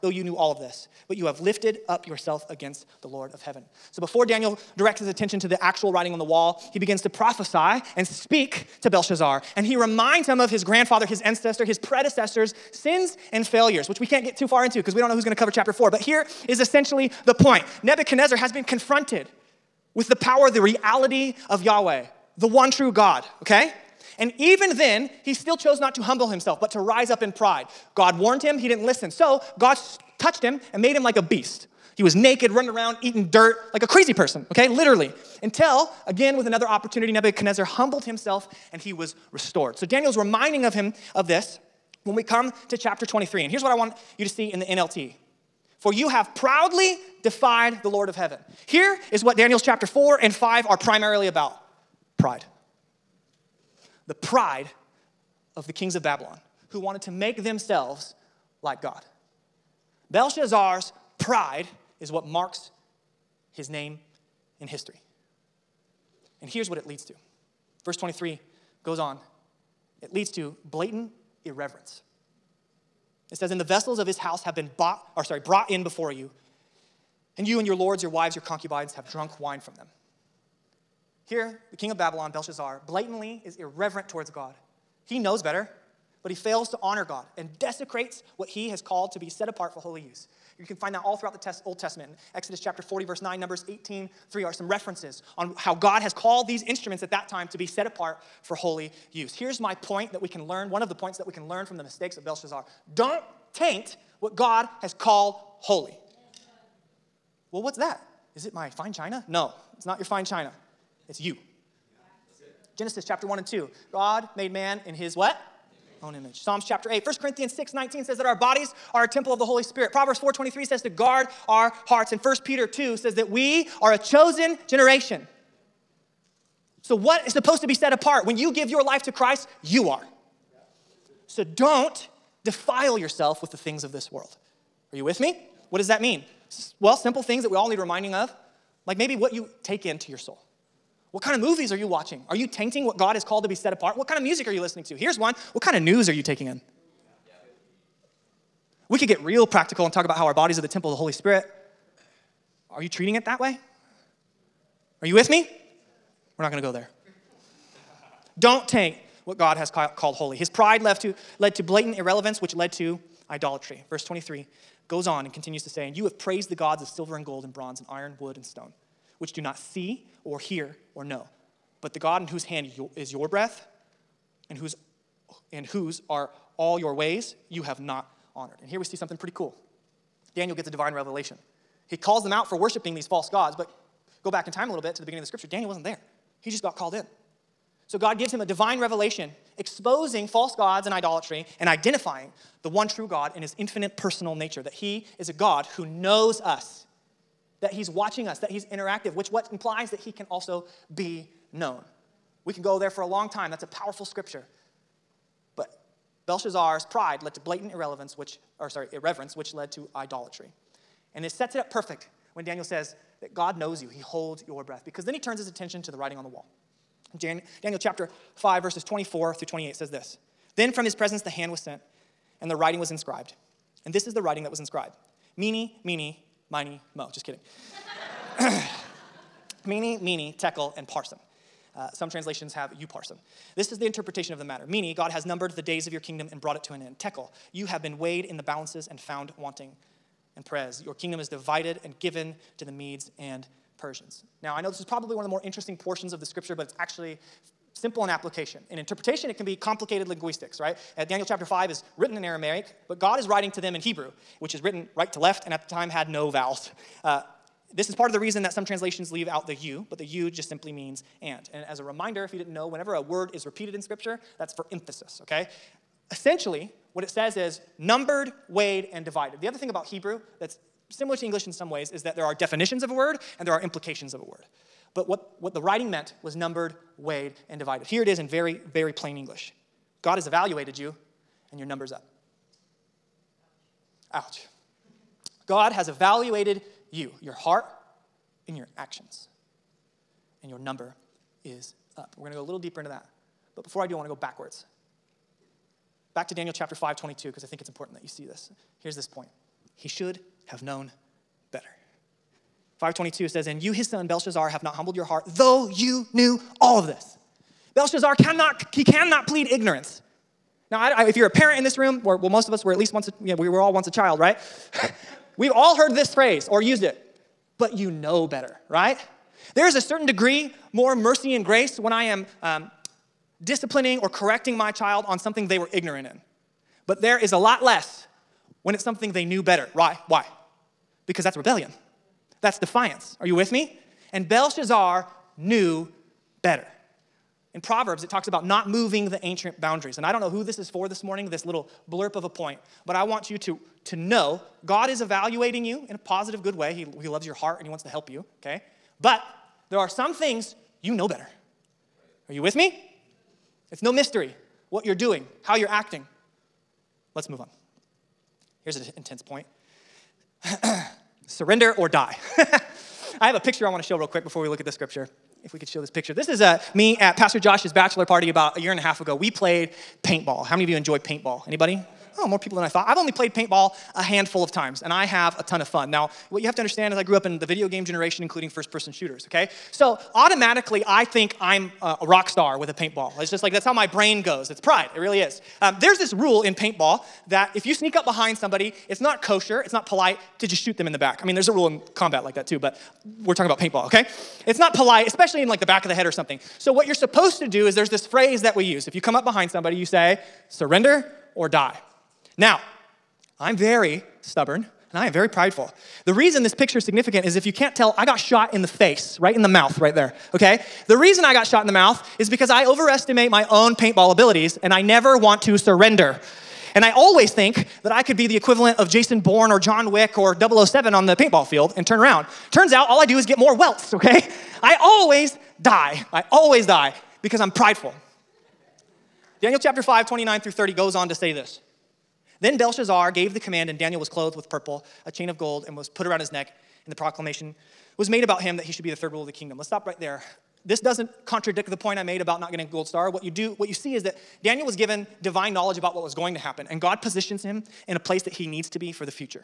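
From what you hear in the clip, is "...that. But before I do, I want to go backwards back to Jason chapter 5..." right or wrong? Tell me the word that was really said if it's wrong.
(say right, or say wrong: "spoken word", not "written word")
wrong: "Daniel", not "Jason".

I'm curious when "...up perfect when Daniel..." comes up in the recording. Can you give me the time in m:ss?
3:31.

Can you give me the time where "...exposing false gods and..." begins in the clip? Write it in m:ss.
3:09.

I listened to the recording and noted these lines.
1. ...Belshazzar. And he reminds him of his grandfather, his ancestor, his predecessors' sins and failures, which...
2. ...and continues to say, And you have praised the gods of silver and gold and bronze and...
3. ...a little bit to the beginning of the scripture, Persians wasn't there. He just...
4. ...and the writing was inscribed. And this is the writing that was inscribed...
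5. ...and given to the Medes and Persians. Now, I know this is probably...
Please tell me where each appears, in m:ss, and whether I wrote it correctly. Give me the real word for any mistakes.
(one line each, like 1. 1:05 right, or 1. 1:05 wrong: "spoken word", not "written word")
1. 0:08 right
2. 2:45 right
3. 3:04 wrong: "Daniel", not "Persians"
4. 3:42 right
5. 4:01 right.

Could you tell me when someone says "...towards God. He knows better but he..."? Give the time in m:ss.
1:24.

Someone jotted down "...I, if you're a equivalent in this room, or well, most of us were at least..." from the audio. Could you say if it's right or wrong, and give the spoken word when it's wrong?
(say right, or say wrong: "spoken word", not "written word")
wrong: "parent", not "equivalent".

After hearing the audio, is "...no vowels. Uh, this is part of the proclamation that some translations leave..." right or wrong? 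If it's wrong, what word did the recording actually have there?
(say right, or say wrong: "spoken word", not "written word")
wrong: "reason", not "proclamation".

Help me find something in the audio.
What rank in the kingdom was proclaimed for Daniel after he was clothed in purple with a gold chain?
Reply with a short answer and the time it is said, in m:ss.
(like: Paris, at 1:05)
third ruler, at 7:18.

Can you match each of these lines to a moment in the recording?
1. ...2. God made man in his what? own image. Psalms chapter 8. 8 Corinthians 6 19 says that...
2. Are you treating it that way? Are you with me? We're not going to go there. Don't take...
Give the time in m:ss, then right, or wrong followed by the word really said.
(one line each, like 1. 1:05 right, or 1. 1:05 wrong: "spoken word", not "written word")
1. 1:53 wrong: "1", not "8"
2. 2:32 right.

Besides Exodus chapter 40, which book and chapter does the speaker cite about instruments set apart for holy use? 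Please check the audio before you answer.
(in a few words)
Numbers 18.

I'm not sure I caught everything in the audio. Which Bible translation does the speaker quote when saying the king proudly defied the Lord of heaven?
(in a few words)
NLT.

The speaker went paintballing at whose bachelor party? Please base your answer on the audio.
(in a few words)
Pastor Josh.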